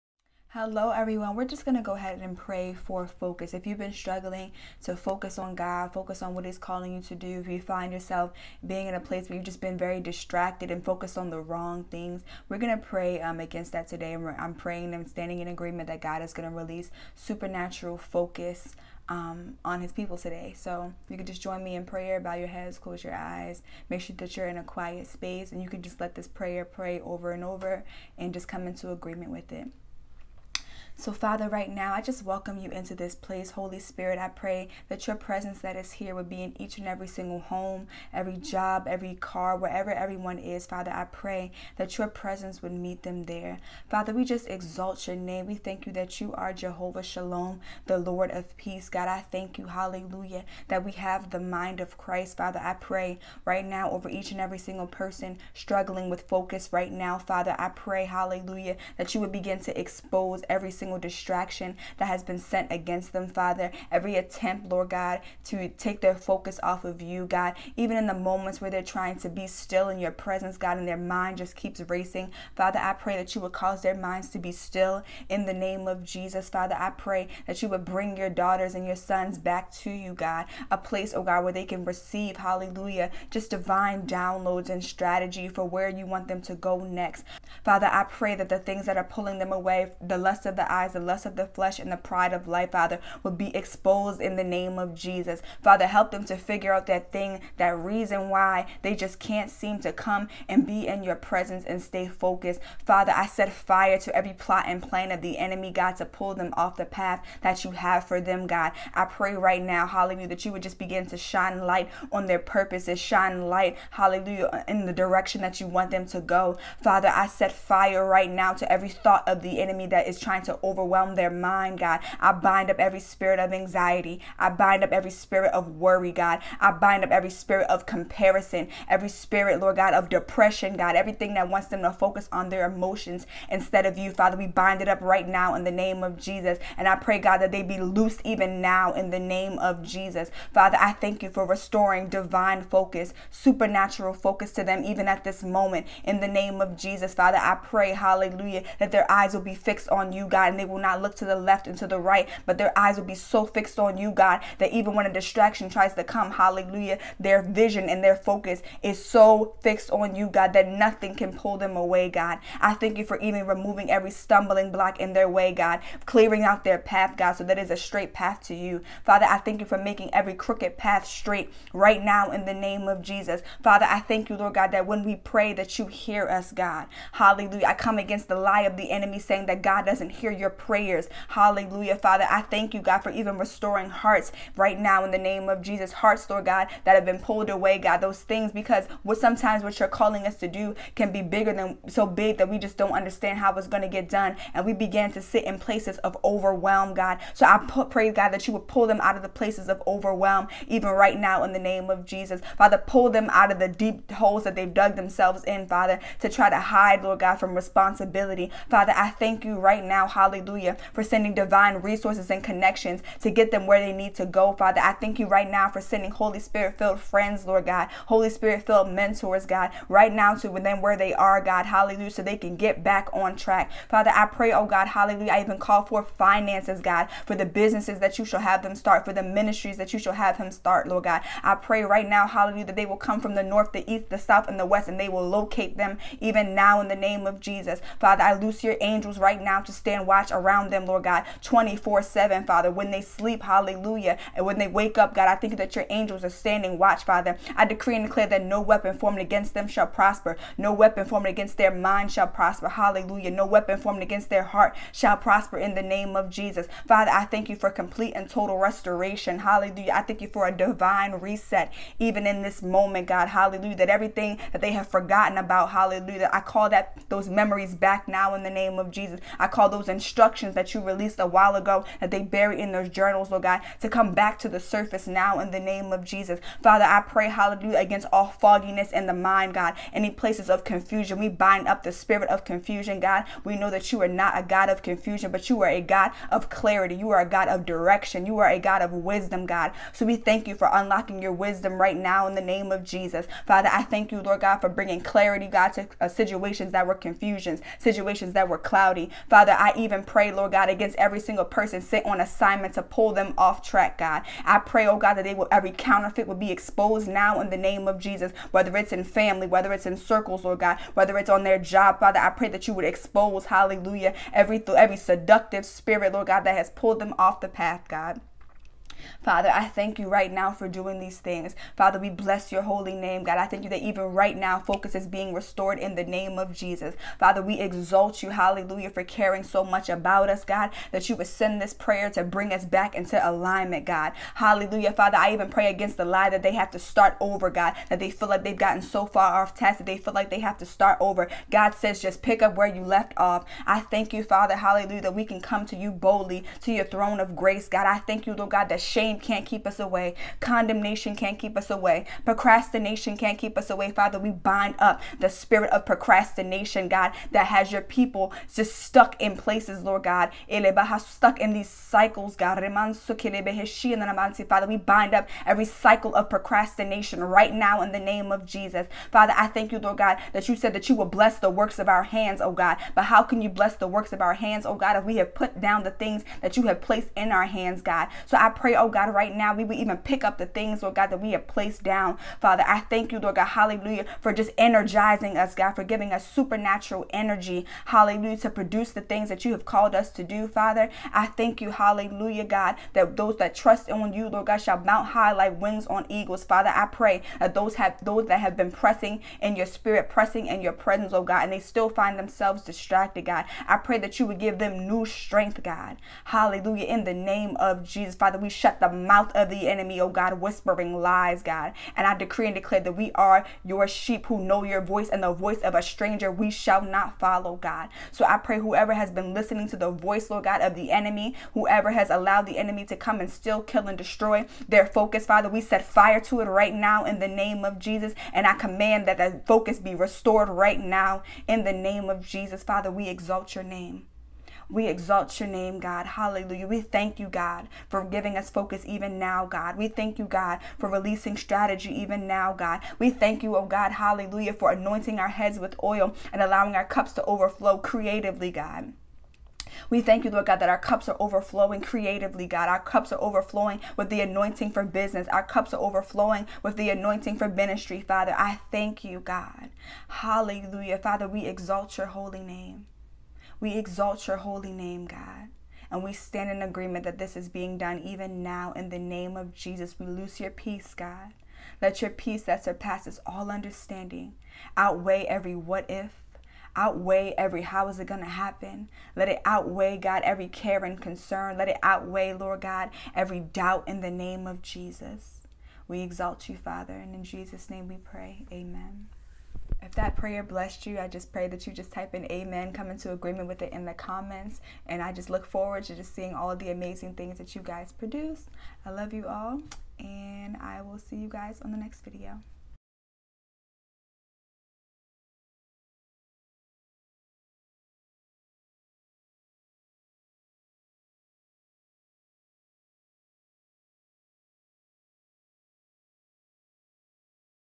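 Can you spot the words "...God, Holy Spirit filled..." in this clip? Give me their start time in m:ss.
3:37.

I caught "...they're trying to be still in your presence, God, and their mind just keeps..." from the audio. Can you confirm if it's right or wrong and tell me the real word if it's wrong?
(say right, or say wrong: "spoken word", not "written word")
right.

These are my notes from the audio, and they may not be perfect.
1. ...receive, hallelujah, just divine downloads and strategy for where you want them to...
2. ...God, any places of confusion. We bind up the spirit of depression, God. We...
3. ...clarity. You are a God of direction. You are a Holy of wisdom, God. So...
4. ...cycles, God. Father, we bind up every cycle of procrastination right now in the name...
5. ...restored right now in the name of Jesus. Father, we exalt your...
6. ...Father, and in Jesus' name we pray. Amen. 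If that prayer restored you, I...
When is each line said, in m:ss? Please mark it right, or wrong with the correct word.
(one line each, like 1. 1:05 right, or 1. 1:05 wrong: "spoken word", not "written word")
1. 1:21 right
2. 4:39 wrong: "confusion", not "depression"
3. 4:46 wrong: "God", not "Holy"
4. 6:01 right
5. 7:09 right
6. 8:06 wrong: "blessed", not "restored".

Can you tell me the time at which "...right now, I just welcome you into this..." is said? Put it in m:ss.
0:31.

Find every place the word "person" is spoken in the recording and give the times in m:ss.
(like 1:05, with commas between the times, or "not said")
0:54, 5:01.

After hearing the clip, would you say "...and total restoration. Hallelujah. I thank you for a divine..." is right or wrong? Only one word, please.
right.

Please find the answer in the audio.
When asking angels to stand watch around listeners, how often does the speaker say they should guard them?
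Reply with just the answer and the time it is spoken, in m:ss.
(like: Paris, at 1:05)
24/7, at 4:01.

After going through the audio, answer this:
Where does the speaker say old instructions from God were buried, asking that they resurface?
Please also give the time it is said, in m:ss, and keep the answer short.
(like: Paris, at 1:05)
Journals, at 4:32.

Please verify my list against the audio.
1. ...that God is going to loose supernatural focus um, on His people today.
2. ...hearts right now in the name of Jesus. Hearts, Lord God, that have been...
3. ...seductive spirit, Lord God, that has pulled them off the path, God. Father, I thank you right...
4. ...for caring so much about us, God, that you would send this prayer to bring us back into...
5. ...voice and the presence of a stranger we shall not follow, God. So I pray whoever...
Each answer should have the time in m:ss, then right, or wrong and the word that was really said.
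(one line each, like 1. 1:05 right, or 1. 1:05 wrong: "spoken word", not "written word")
1. 0:15 wrong: "release", not "loose"
2. 3:03 right
3. 5:14 right
4. 5:28 right
5. 6:54 wrong: "voice", not "presence".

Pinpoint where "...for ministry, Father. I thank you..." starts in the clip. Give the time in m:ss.
7:37.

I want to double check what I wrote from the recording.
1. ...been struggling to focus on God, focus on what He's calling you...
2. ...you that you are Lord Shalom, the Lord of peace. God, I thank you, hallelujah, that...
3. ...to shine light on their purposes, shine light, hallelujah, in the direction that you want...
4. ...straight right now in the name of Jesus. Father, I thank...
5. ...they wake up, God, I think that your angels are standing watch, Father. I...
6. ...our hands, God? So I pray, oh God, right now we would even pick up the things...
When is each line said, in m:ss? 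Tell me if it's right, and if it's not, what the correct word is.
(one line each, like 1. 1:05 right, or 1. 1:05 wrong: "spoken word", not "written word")
1. 0:03 right
2. 0:45 wrong: "Jehovah", not "Lord"
3. 1:51 right
4. 2:51 right
5. 4:04 right
6. 6:17 right.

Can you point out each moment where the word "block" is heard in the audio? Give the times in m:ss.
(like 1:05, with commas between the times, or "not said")
2:44.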